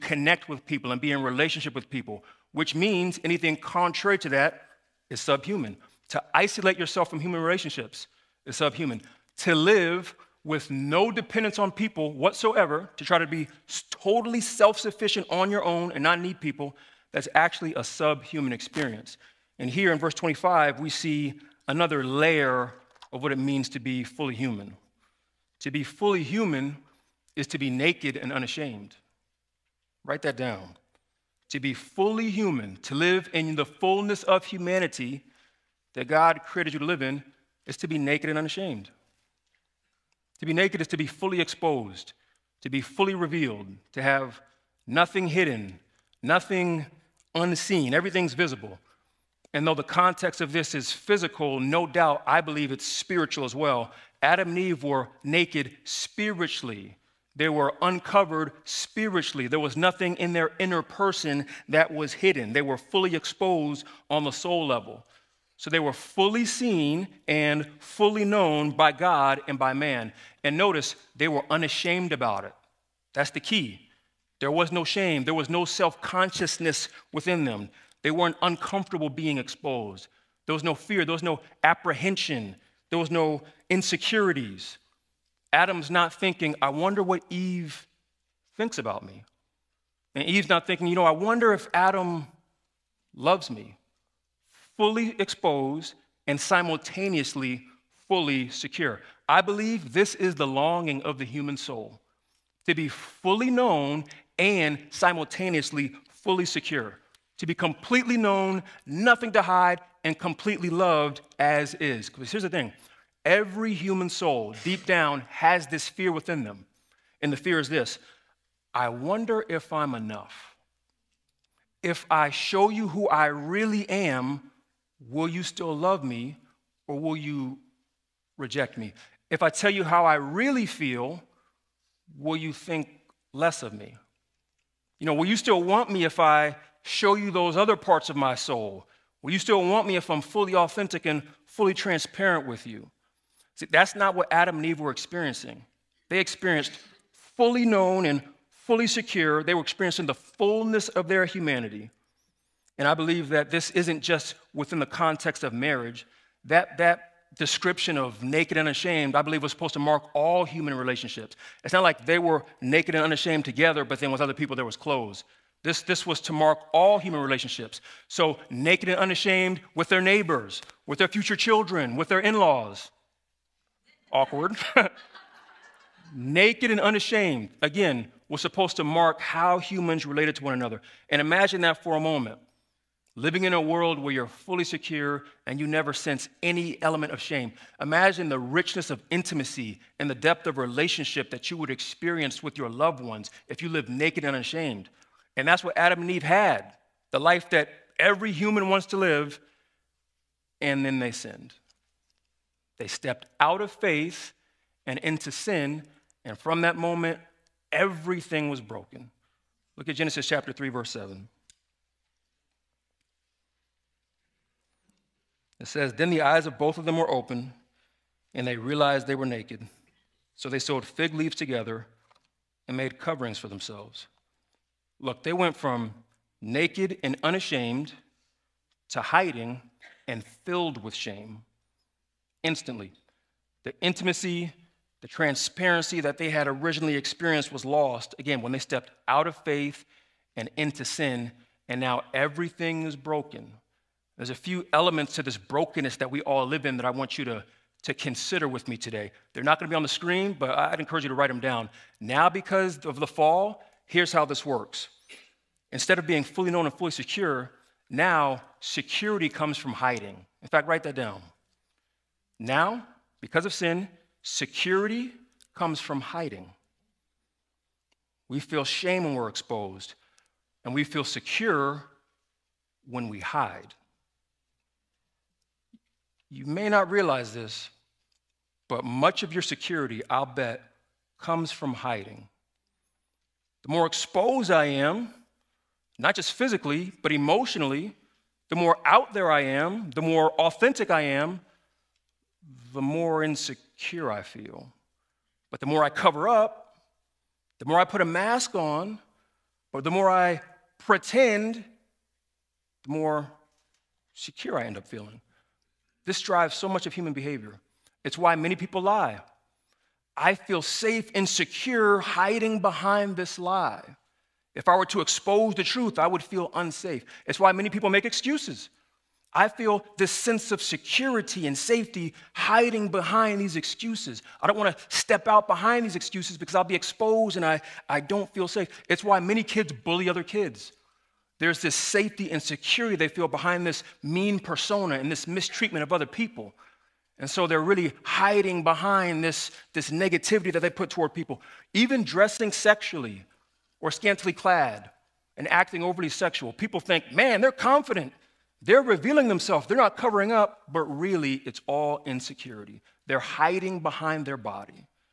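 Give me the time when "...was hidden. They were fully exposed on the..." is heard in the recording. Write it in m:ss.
1:01.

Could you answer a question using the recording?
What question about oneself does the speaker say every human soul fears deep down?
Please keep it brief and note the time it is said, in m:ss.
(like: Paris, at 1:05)
If I'm enough, at 1:58.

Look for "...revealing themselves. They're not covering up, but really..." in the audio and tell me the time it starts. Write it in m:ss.
5:48.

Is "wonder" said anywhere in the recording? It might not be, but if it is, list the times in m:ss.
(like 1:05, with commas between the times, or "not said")
1:26, 1:31, 1:58.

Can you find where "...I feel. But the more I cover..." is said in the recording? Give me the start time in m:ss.
4:54.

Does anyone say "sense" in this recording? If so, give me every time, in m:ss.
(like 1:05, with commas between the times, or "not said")
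3:05, 5:20.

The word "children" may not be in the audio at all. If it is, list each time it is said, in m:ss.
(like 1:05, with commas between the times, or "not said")
2:51.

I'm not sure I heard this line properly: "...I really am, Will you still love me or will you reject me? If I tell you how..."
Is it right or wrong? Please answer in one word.
right.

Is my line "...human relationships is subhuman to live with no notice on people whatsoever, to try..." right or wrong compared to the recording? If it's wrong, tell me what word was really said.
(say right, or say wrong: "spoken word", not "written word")
wrong: "dependence", not "notice".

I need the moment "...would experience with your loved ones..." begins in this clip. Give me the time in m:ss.
3:11.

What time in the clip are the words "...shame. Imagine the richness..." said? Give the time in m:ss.
3:07.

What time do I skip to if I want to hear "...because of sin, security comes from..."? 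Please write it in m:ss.
4:23.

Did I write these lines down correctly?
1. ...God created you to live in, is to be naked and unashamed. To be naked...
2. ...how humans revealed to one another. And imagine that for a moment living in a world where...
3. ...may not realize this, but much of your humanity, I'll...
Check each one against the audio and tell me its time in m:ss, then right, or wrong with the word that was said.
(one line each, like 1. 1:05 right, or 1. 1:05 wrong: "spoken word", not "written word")
1. 0:36 right
2. 2:59 wrong: "related", not "revealed"
3. 4:36 wrong: "security", not "humanity".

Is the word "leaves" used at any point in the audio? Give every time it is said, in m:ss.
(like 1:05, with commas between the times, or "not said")
3:41.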